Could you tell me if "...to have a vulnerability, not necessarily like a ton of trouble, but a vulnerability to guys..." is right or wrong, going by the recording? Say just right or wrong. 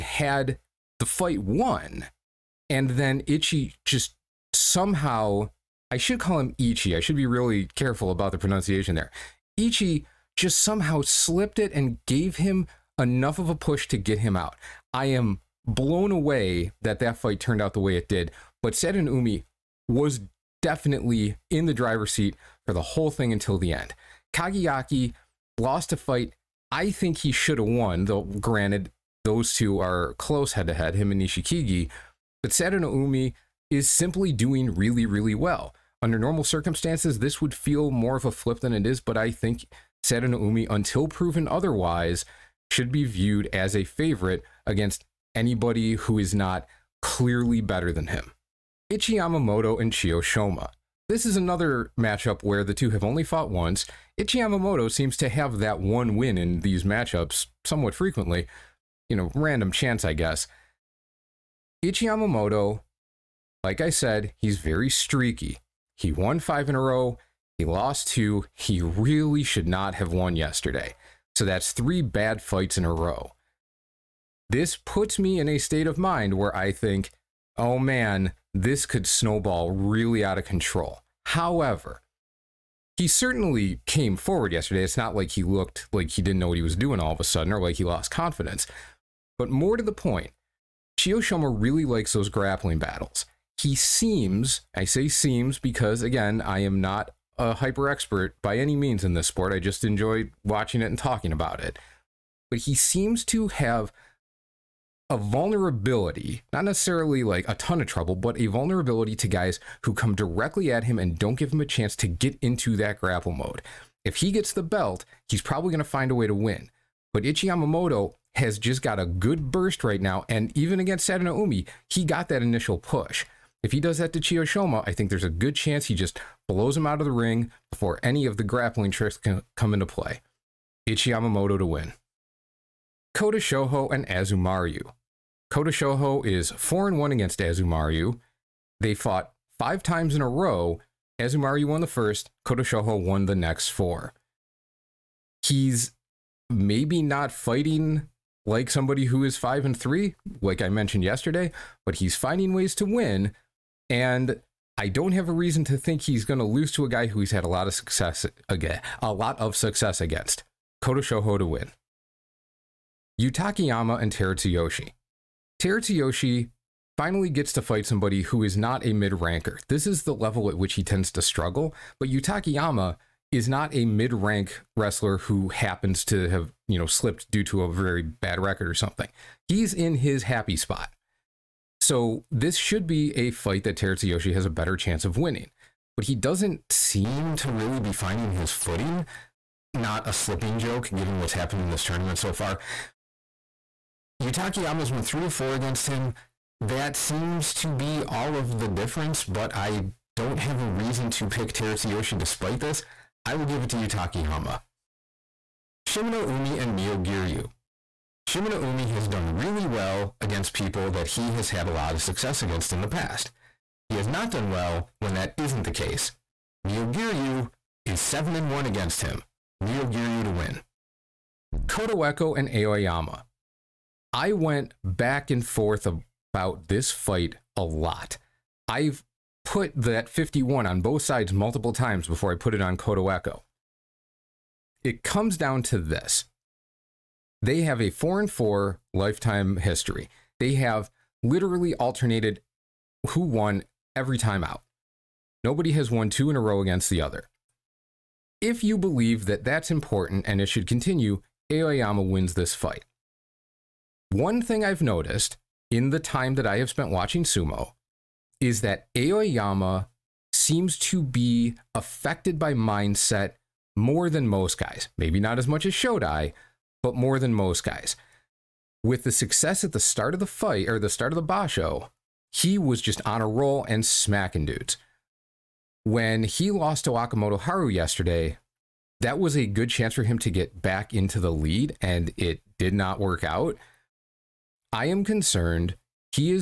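right.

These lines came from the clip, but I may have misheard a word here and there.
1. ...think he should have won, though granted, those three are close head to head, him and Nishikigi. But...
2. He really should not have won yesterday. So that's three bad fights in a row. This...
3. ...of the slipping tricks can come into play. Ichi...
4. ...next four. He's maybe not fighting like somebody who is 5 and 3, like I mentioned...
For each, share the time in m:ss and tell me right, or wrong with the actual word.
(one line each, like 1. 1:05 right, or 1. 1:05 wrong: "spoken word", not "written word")
1. 0:26 wrong: "two", not "three"
2. 1:08 right
3. 2:08 wrong: "grappling", not "slipping"
4. 2:23 right.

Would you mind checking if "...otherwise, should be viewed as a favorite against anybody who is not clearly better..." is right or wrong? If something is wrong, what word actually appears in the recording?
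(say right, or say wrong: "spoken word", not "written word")
right.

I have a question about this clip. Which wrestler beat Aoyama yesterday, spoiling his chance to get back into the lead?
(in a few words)
Wakamoto Haru.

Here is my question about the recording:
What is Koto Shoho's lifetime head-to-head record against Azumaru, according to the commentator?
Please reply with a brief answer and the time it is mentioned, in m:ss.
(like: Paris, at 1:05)
4 and 1, at 2:15.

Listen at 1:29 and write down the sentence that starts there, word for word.
But more to the point, Chiyoshoma really likes those grappling battles.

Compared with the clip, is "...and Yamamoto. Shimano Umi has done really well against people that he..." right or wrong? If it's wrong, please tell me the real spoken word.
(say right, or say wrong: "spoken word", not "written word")
wrong: "Myogiryu", not "Yamamoto".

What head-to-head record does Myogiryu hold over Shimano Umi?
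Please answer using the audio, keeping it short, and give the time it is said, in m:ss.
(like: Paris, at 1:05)
7 and 1, at 3:36.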